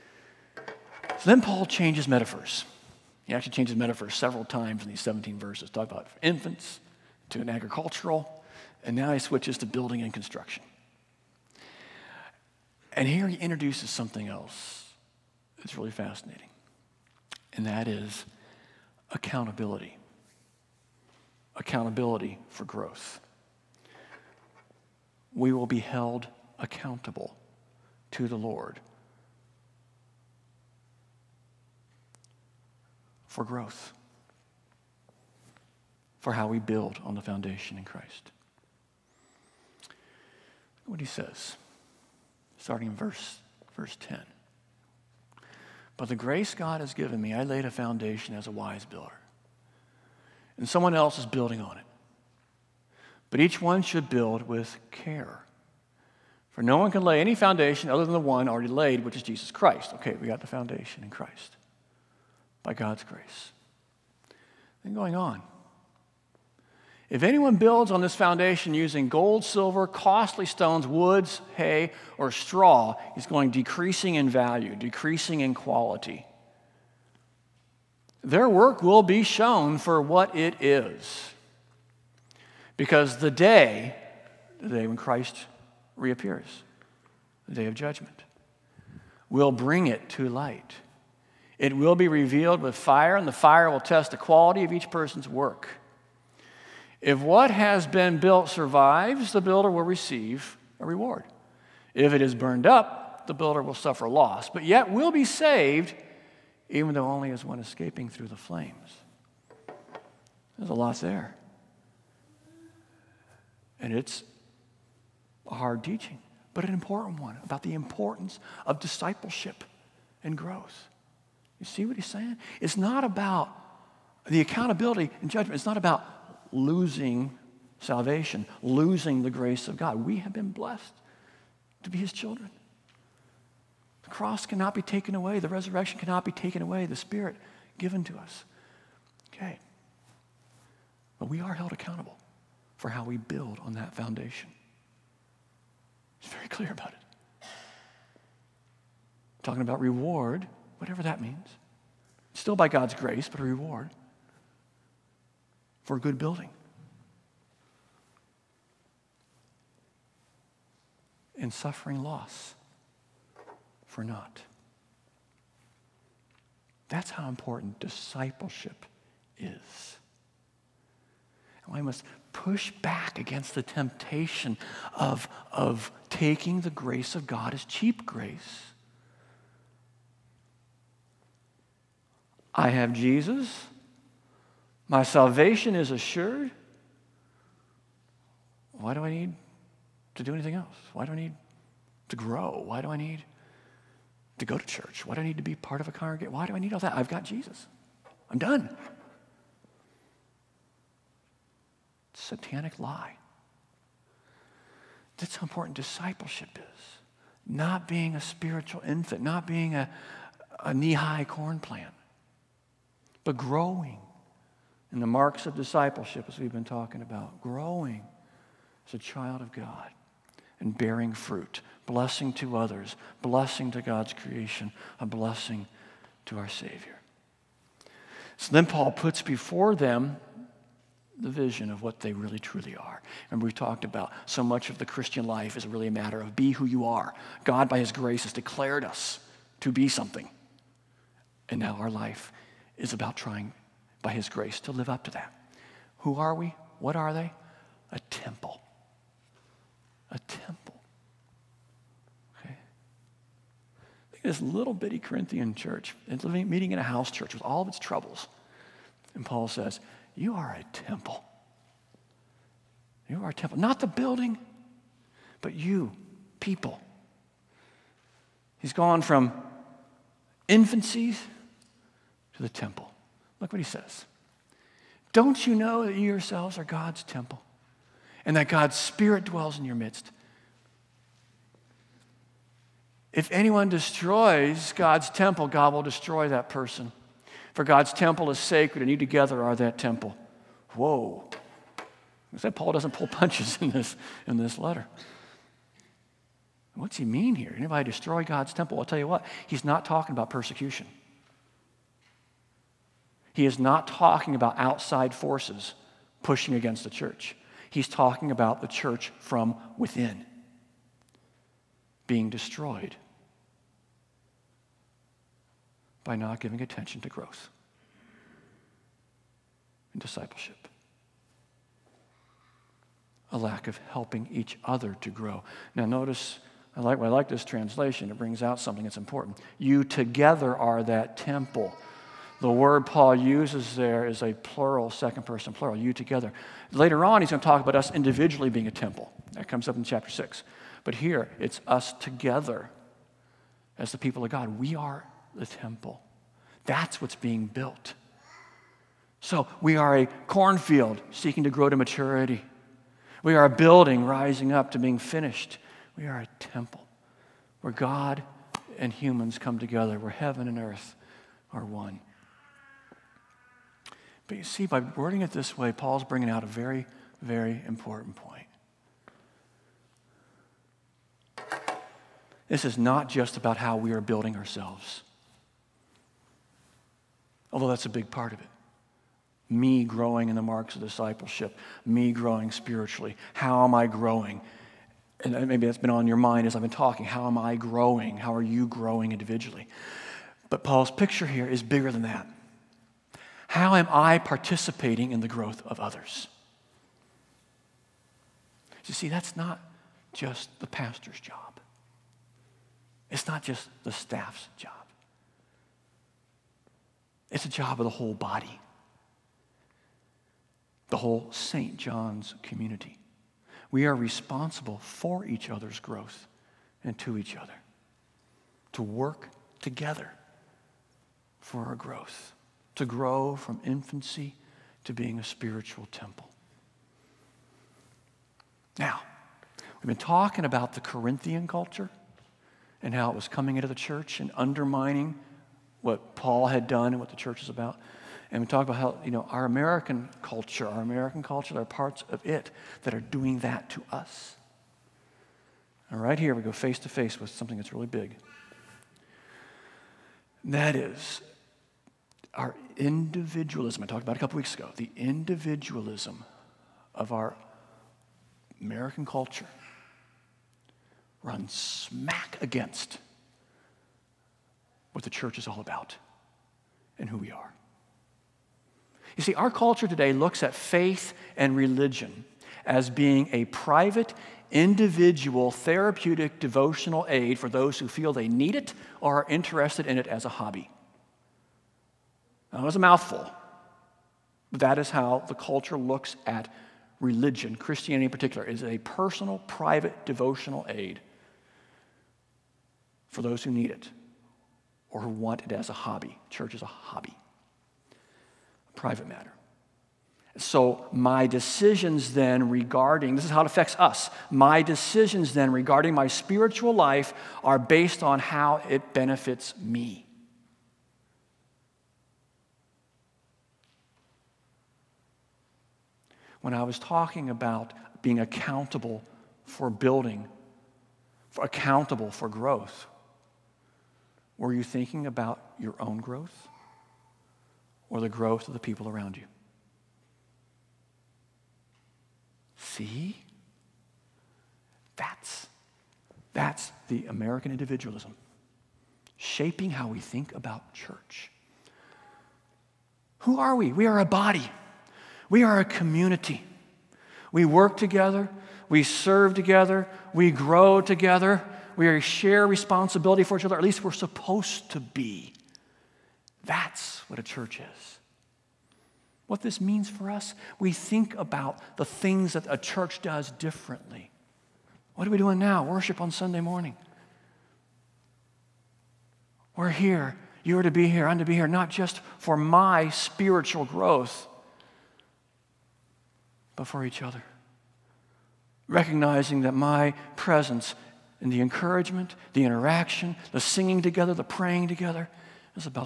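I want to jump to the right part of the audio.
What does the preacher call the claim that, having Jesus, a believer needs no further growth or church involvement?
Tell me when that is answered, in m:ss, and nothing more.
3:22.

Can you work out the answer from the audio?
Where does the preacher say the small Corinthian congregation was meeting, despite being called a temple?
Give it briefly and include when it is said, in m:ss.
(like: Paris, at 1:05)
a house church, at 4:16.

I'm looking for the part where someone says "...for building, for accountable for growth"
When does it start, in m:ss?
8:39.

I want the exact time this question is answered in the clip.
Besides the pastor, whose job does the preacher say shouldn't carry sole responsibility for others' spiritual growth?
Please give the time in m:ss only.
6:43.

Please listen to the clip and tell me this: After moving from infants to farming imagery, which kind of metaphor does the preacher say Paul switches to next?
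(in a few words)
building and construction.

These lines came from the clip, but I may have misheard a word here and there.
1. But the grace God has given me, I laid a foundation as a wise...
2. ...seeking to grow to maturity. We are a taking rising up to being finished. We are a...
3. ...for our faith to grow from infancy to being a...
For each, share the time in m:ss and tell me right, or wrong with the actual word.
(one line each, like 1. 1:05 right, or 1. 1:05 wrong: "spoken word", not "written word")
1. 0:45 right
2. 5:51 wrong: "building", not "taking"
3. 7:01 wrong: "growth", not "faith".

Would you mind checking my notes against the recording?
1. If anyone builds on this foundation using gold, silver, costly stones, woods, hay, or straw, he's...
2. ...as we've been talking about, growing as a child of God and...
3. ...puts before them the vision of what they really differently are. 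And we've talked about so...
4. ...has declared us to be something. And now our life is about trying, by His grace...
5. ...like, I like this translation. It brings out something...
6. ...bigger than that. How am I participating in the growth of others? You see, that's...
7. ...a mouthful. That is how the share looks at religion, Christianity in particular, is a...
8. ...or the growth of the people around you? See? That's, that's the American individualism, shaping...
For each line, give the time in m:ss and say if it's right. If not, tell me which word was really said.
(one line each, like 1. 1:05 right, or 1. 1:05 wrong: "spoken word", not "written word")
1. 1:07 right
2. 3:36 right
3. 3:48 wrong: "truly", not "differently"
4. 3:58 right
5. 5:26 right
6. 6:31 right
7. 8:02 wrong: "culture", not "share"
8. 8:47 right.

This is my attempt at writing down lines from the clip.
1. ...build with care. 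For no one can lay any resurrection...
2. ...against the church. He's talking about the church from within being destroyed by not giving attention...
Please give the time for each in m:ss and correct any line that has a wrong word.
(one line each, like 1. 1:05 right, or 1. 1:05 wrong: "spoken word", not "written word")
1. 0:54 wrong: "foundation", not "resurrection"
2. 5:06 right.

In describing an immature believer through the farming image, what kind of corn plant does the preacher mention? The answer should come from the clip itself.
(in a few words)
knee high corn plant.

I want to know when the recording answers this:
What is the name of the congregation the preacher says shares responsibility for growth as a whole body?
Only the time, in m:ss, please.
6:51.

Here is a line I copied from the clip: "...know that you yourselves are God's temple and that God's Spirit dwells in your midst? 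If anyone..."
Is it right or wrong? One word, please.
right.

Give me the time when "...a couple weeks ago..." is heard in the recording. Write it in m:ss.
7:34.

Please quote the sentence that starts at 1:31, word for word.
It will be revealed with fire, and the fire will test the quality of each person's work.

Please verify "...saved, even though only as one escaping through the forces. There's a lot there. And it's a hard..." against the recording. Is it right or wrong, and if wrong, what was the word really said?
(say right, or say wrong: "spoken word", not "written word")
wrong: "flames", not "forces".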